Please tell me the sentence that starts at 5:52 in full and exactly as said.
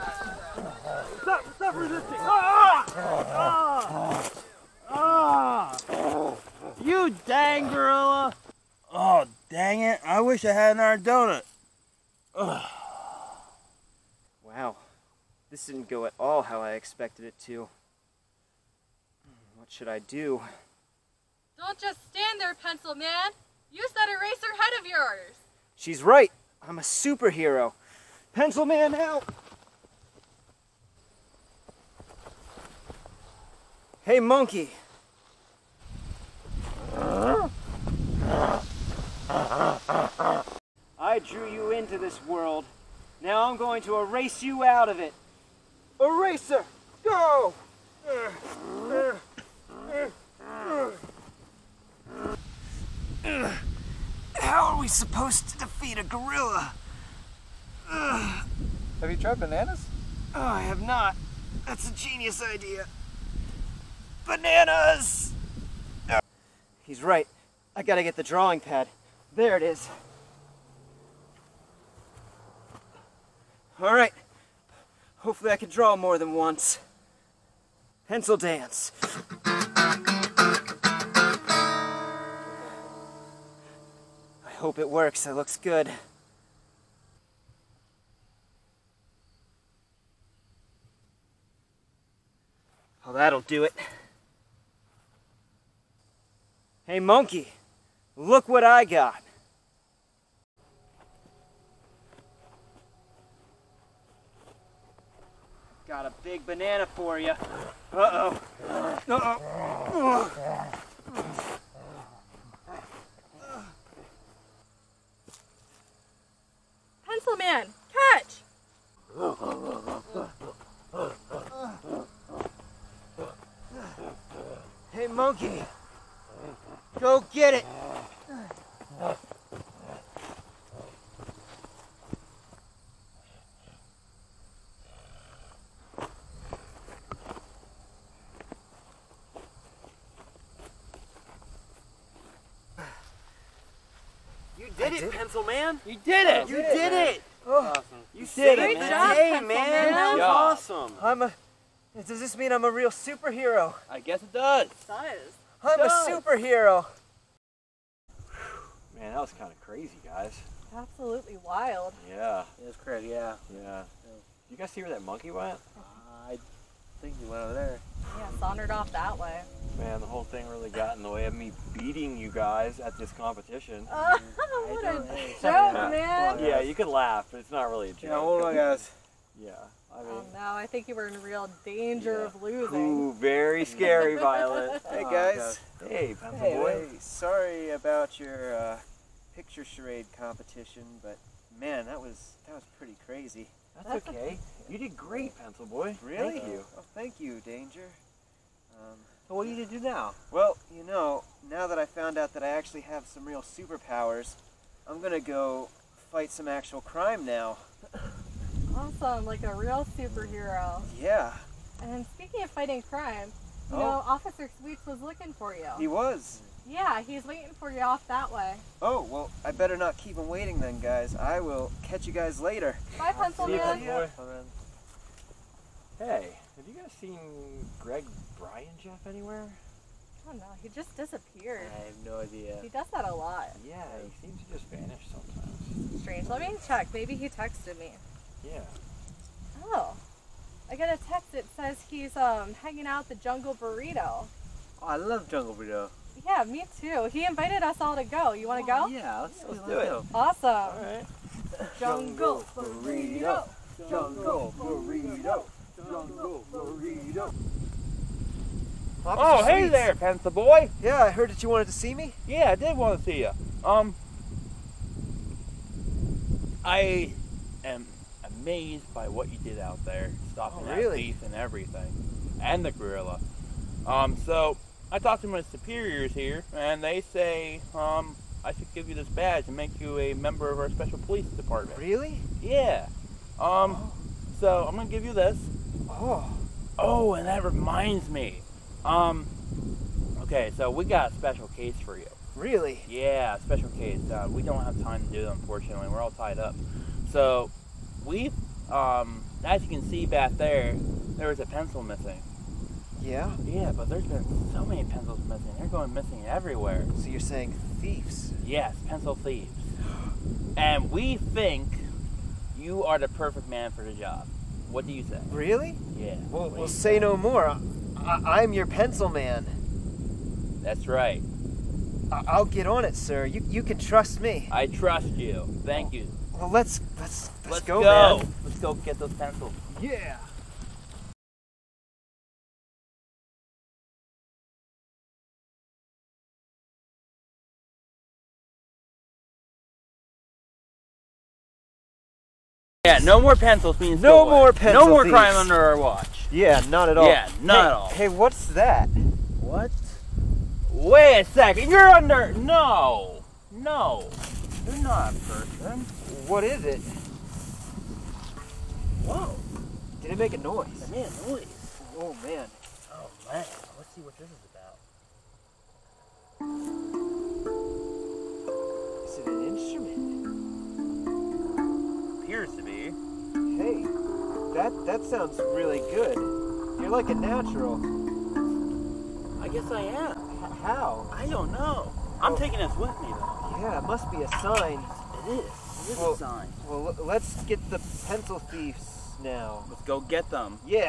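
No, no, you're not a person.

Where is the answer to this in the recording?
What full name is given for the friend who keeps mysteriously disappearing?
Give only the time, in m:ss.
3:47.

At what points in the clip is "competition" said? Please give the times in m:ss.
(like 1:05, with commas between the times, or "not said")
2:53, 3:10.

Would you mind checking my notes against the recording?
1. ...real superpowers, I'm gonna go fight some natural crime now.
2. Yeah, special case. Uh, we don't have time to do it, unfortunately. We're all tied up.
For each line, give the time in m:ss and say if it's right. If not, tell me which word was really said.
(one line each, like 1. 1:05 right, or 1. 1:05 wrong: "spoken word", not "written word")
1. 3:23 wrong: "actual", not "natural"
2. 4:52 right.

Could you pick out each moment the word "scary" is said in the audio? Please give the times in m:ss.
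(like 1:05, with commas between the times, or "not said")
3:03.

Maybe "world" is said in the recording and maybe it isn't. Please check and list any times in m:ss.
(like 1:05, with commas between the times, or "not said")
0:42.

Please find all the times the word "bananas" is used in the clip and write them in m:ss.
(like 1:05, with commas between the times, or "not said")
0:59, 1:04, 1:46.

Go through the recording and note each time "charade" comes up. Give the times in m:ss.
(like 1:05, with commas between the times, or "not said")
3:09.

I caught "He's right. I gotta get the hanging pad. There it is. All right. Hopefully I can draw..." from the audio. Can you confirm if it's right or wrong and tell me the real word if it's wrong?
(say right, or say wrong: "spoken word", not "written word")
wrong: "drawing", not "hanging".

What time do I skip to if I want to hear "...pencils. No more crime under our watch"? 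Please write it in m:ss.
5:44.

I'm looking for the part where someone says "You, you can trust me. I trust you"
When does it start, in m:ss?
5:23.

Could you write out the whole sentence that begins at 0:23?
Use that eraser head of yours!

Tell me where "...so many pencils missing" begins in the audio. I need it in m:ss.
5:04.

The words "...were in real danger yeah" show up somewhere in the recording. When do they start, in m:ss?
3:00.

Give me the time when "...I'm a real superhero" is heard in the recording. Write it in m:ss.
2:32.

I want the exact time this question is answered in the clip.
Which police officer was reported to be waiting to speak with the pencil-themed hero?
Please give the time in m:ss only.
3:34.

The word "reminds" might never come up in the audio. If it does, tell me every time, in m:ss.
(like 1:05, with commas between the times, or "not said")
4:47.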